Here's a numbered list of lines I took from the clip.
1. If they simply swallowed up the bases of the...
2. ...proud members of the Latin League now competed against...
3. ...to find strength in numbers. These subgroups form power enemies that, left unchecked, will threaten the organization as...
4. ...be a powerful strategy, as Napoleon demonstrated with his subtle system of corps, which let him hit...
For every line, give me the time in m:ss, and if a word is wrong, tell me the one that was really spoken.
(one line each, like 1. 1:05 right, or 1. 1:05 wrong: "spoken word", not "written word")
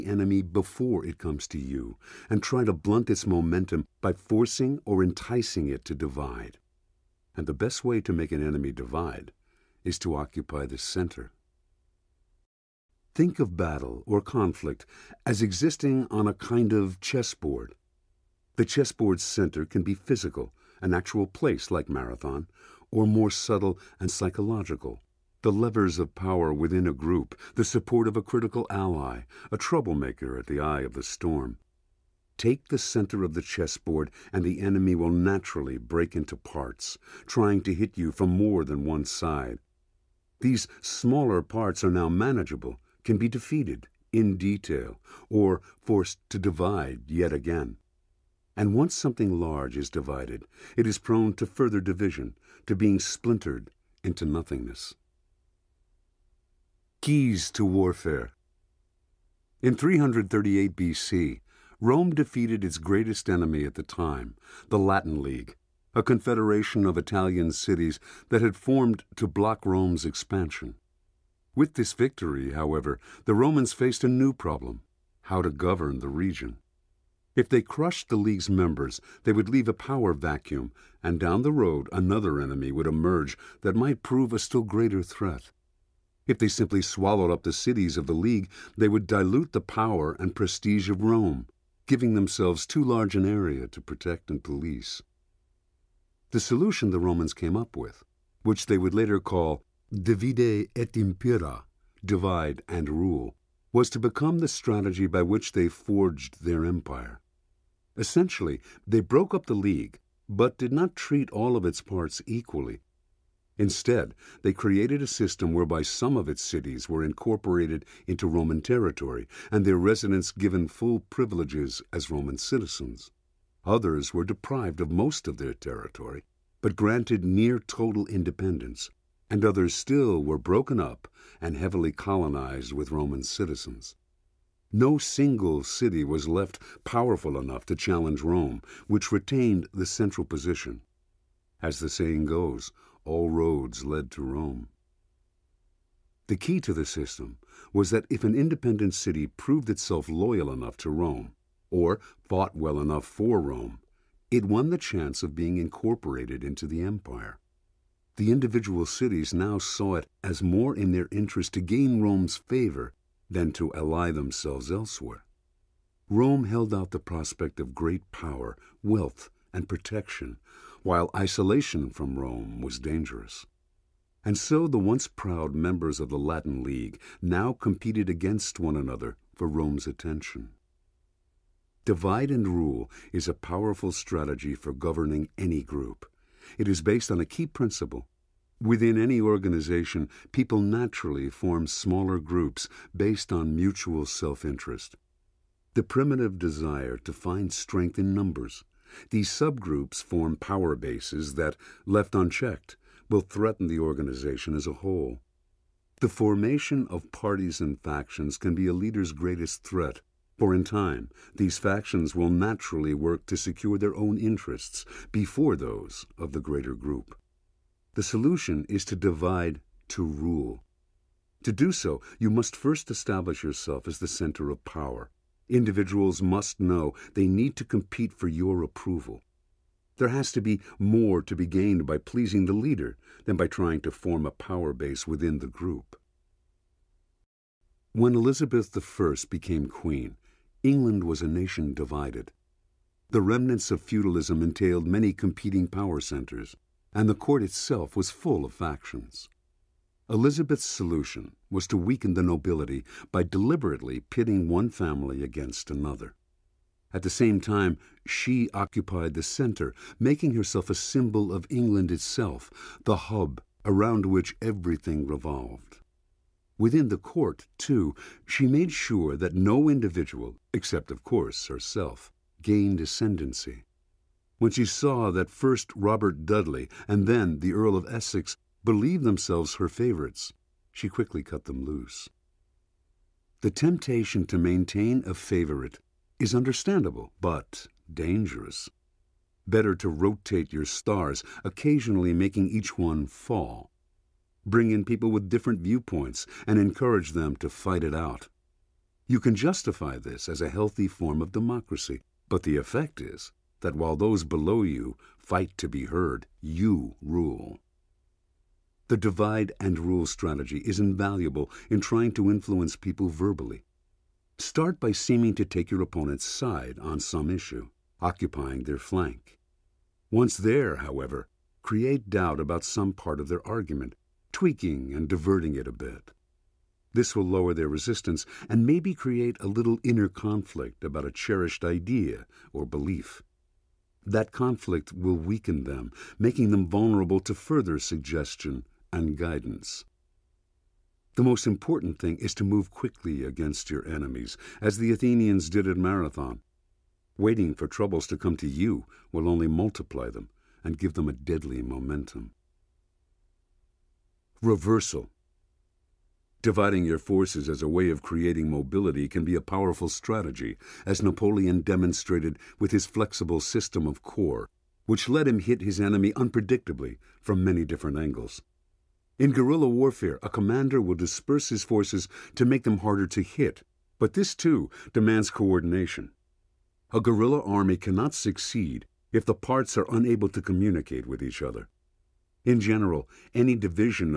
1. 1:26 wrong: "cities", not "bases"
2. 2:55 right
3. 3:16 wrong: "bases", not "enemies"
4. 5:59 wrong: "flexible", not "subtle".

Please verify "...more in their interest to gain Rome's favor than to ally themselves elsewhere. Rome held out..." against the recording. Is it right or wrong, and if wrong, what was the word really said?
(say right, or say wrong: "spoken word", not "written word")
right.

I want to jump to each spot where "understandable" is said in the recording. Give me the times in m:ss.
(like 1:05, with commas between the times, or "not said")
4:46.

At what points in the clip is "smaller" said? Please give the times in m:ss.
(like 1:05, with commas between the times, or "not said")
0:40, 3:11.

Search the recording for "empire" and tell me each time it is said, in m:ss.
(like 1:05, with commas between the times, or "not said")
1:46, 2:36.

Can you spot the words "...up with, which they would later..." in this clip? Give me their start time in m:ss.
1:37.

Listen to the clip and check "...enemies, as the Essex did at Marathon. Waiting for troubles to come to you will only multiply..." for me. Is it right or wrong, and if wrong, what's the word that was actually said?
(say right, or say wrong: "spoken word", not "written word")
wrong: "Athenians", not "Essex".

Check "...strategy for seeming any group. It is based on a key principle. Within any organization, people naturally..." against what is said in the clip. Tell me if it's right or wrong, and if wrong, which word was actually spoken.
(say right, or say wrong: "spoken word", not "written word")
wrong: "governing", not "seeming".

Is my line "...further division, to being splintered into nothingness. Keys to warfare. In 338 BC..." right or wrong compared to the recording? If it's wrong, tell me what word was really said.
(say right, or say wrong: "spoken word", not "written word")
right.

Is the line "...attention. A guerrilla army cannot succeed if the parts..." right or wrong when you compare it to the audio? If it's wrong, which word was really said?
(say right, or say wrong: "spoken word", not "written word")
wrong: "coordination", not "attention".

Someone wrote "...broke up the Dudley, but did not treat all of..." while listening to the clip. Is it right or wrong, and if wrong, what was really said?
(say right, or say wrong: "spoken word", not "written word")
wrong: "League", not "Dudley".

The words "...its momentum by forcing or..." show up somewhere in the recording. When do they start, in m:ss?
0:03.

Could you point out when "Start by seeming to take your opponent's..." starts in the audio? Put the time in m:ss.
5:14.